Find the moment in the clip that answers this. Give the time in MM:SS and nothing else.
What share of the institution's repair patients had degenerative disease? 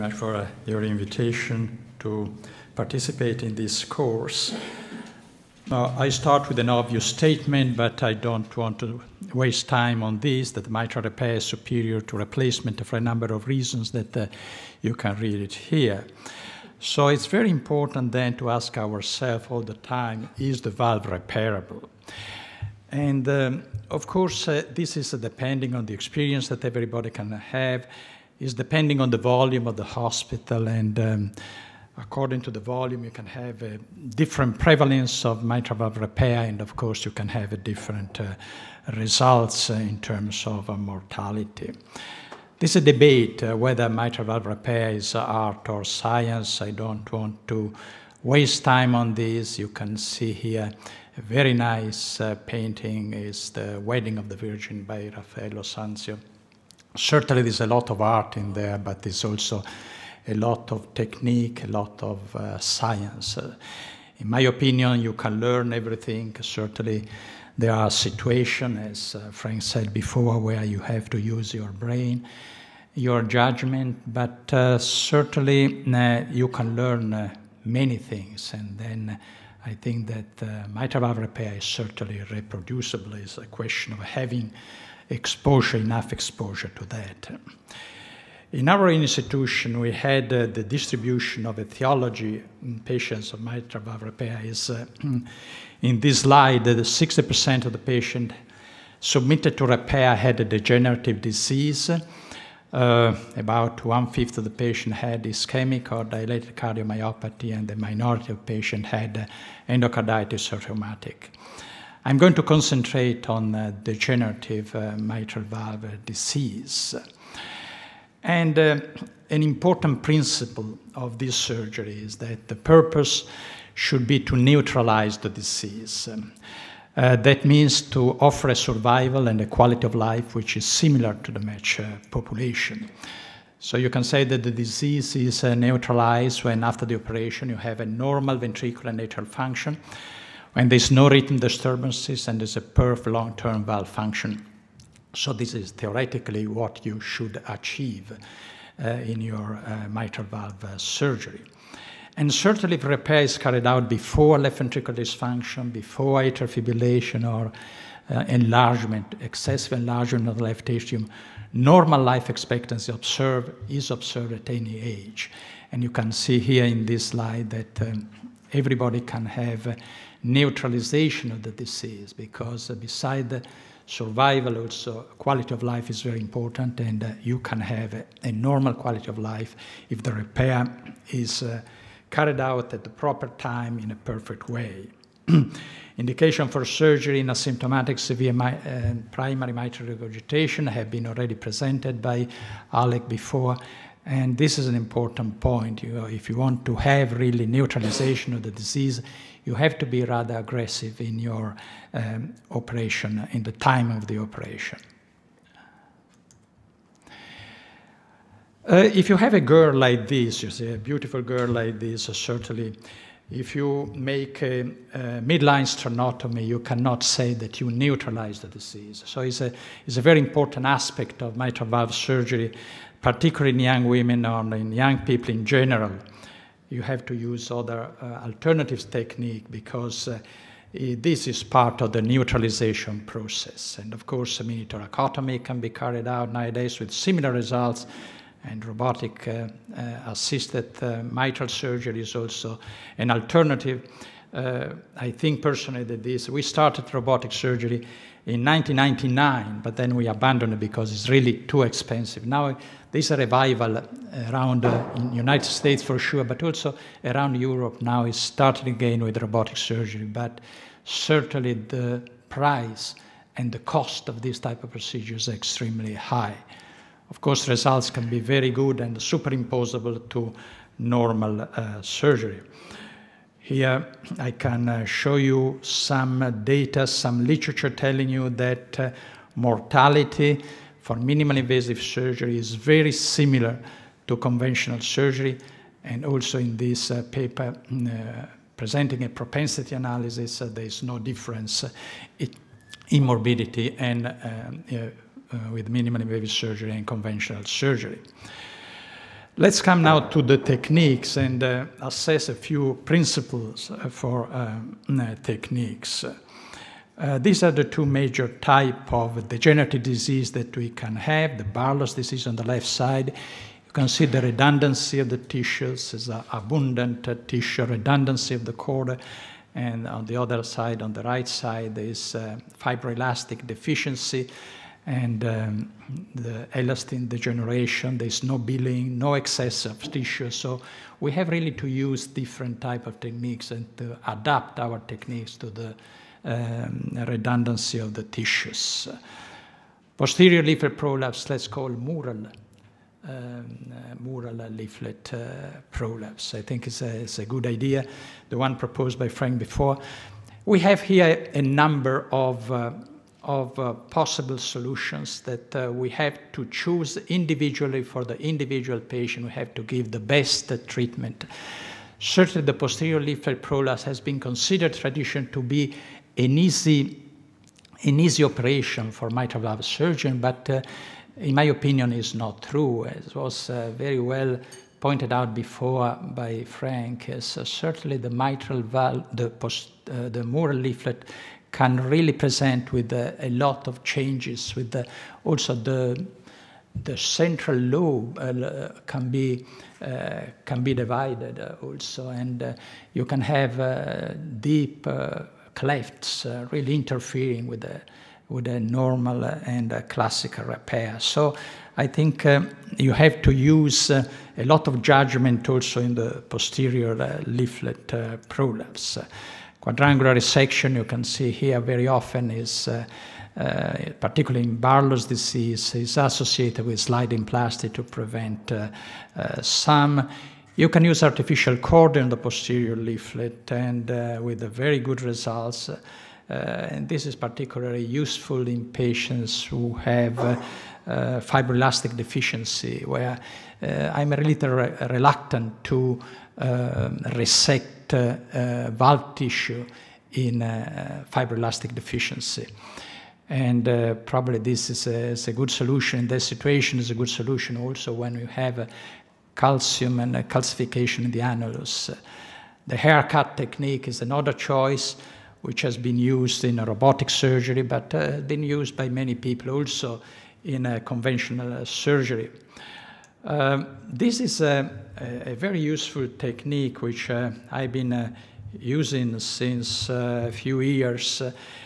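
01:36.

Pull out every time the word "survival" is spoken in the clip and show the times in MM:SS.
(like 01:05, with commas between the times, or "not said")
02:08, 02:53.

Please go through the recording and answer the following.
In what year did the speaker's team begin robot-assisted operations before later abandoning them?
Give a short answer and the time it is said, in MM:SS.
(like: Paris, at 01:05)
1999, at 04:08.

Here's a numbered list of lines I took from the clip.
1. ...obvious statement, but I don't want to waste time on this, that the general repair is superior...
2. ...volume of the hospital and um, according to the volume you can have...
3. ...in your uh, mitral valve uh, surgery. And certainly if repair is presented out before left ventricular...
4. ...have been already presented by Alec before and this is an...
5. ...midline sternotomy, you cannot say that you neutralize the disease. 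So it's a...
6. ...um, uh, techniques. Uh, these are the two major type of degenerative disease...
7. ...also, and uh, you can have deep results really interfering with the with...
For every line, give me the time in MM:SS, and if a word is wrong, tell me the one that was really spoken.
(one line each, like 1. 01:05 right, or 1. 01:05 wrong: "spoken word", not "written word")
1. 00:06 wrong: "mitral", not "general"
2. 00:29 right
3. 02:28 wrong: "carried", not "presented"
4. 03:10 right
5. 03:35 right
6. 05:04 right
7. 06:31 wrong: "clefts", not "results".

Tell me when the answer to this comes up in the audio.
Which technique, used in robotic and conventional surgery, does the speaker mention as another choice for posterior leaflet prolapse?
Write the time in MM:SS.
07:32.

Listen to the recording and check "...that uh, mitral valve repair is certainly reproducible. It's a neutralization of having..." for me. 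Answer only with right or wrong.
wrong.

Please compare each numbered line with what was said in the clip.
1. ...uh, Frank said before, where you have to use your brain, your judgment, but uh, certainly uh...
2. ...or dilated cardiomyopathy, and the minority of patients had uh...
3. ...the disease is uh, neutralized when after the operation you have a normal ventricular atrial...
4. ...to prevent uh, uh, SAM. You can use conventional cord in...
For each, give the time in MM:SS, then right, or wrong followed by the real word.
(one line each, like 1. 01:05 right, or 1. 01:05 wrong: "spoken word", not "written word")
1. 01:09 right
2. 01:45 right
3. 02:14 right
4. 06:57 wrong: "artificial", not "conventional".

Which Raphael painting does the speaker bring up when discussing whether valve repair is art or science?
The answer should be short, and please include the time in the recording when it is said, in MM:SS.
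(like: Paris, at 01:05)
The Wedding of the Virgin, at 00:53.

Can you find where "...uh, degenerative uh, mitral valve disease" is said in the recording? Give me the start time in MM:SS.
01:53.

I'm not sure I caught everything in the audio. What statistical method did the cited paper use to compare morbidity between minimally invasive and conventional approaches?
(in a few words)
Propensity analysis.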